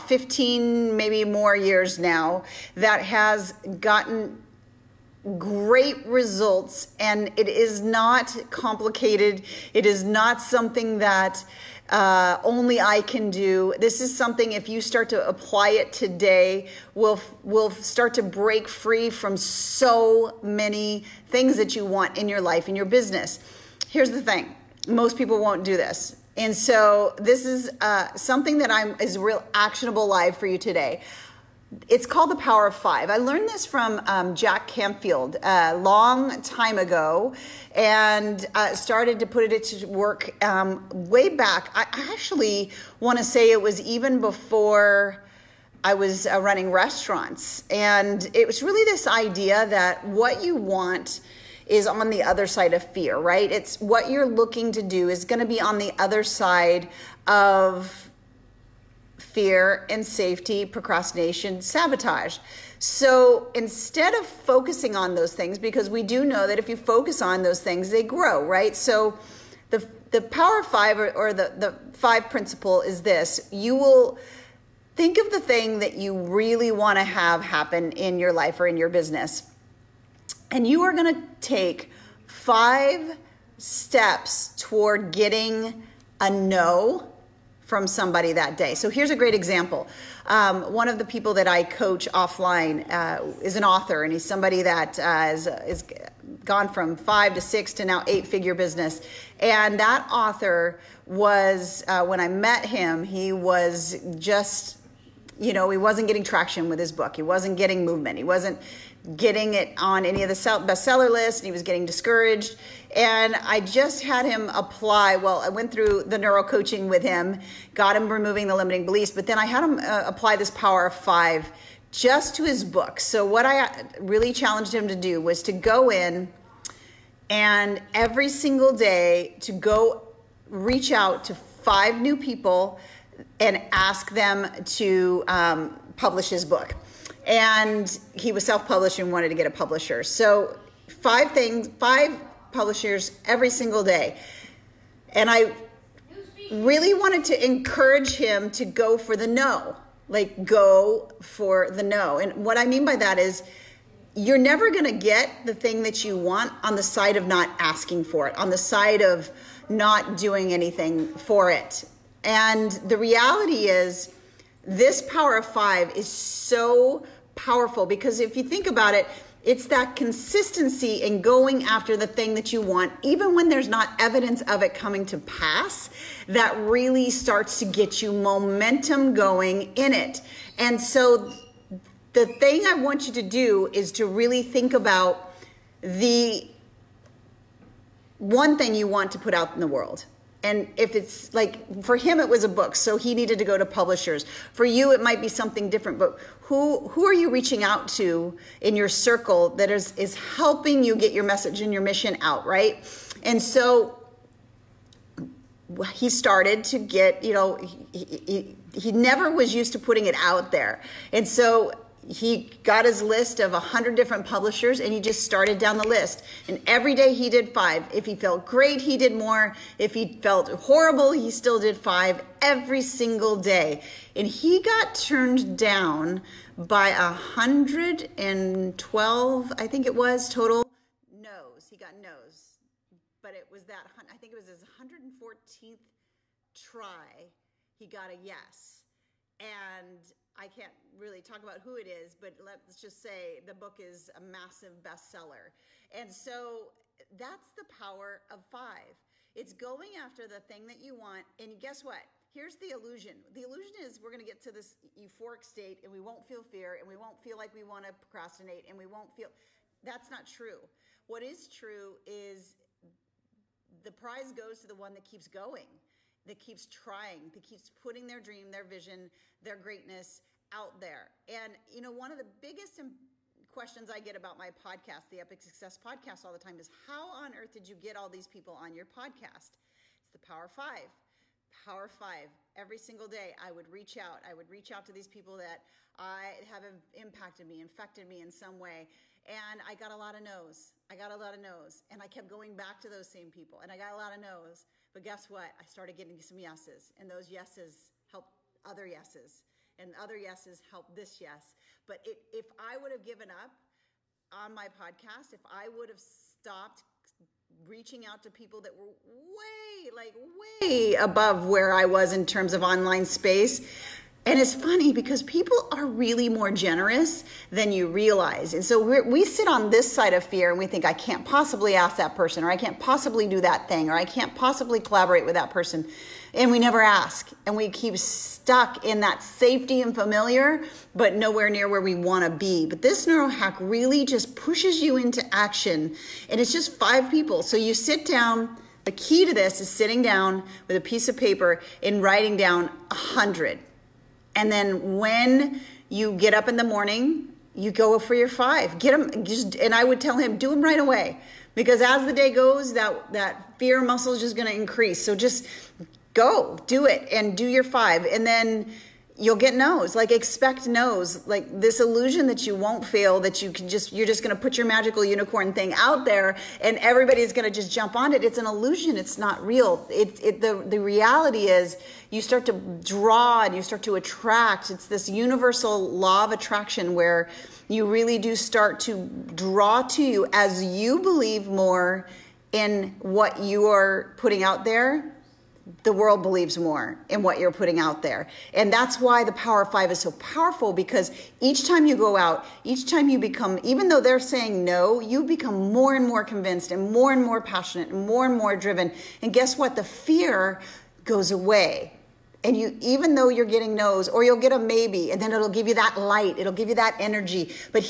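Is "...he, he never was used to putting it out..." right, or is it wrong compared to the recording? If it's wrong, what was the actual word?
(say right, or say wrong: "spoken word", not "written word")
right.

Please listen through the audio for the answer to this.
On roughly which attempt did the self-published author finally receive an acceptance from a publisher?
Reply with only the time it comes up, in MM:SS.
03:54.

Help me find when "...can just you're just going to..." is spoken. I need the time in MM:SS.
06:03.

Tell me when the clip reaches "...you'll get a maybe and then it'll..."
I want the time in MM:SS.
06:44.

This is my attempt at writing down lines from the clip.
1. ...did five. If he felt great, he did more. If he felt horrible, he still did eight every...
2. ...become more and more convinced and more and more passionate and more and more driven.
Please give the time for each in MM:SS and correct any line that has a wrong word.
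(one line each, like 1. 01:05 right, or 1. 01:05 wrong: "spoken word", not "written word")
1. 03:37 wrong: "five", not "eight"
2. 06:35 right.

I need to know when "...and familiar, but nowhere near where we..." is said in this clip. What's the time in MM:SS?
05:29.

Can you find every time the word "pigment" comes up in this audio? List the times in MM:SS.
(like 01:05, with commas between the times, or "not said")
not said.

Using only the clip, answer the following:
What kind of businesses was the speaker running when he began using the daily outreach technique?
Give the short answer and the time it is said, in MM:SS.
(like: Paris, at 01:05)
restaurants, at 00:46.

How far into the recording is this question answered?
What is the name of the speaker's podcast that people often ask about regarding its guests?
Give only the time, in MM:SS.
04:35.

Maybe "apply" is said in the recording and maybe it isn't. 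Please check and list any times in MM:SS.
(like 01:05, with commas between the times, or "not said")
00:15, 01:54, 02:00.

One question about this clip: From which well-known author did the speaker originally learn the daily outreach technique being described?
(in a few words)
Jack Canfield.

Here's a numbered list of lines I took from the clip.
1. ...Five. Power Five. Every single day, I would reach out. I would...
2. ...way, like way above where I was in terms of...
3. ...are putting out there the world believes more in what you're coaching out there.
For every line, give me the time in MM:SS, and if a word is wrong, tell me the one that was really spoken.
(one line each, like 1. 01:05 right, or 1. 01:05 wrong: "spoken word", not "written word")
1. 04:40 right
2. 05:09 right
3. 06:23 wrong: "putting", not "coaching".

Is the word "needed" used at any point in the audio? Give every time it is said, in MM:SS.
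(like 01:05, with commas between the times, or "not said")
03:13.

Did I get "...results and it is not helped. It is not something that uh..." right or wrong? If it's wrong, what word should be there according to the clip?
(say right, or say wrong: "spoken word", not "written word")
wrong: "complicated", not "helped".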